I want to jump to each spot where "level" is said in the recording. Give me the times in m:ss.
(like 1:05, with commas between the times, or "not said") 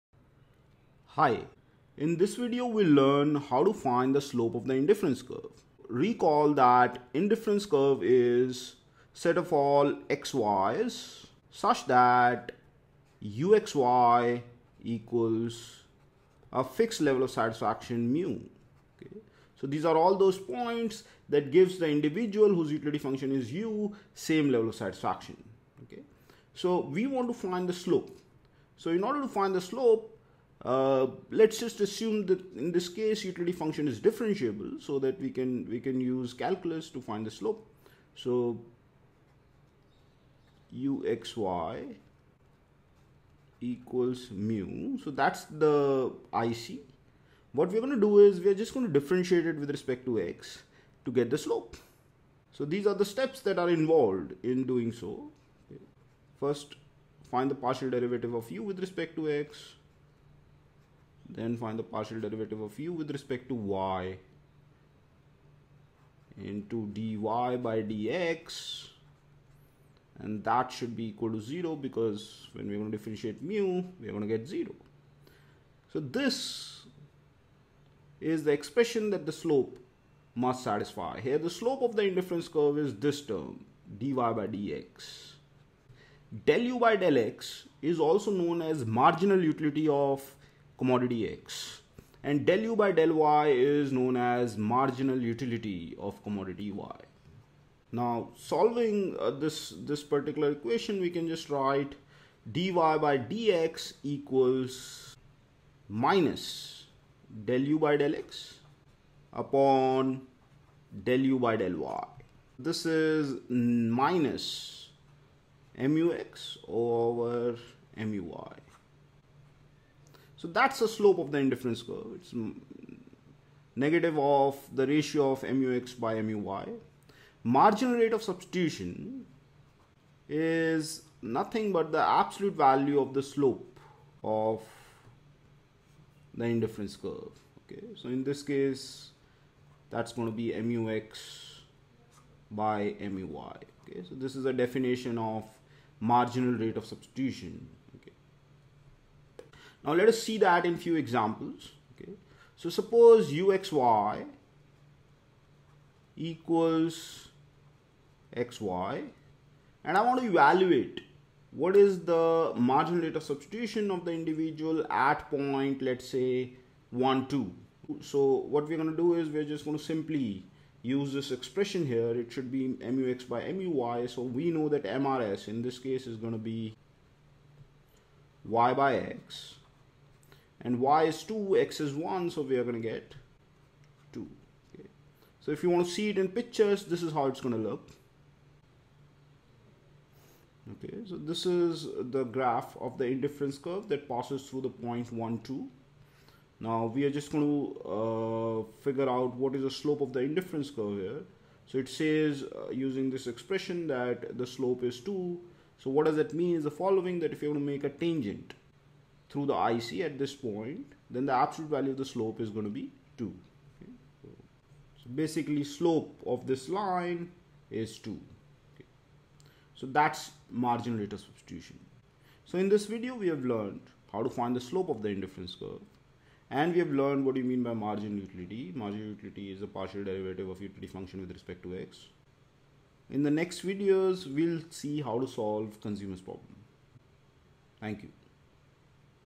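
0:17, 0:24.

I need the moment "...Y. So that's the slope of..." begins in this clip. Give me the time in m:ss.
1:57.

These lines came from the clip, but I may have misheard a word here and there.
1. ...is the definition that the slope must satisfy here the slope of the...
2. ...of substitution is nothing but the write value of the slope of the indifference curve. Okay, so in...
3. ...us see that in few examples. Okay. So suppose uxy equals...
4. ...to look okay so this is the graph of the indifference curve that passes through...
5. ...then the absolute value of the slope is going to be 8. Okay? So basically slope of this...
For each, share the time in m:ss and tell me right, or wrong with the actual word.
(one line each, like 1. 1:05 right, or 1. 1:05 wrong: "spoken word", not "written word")
1. 1:18 wrong: "expression", not "definition"
2. 2:08 wrong: "absolute", not "write"
3. 2:30 right
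4. 3:07 right
5. 3:31 wrong: "2", not "8".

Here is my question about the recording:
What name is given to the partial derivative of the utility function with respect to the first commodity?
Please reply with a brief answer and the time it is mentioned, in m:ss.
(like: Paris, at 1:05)
marginal utility of commodity X, at 1:28.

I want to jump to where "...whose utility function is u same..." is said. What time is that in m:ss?
0:22.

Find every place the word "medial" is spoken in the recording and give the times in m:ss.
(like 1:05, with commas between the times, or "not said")
not said.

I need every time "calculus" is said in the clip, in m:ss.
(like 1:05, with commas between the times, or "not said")
0:36.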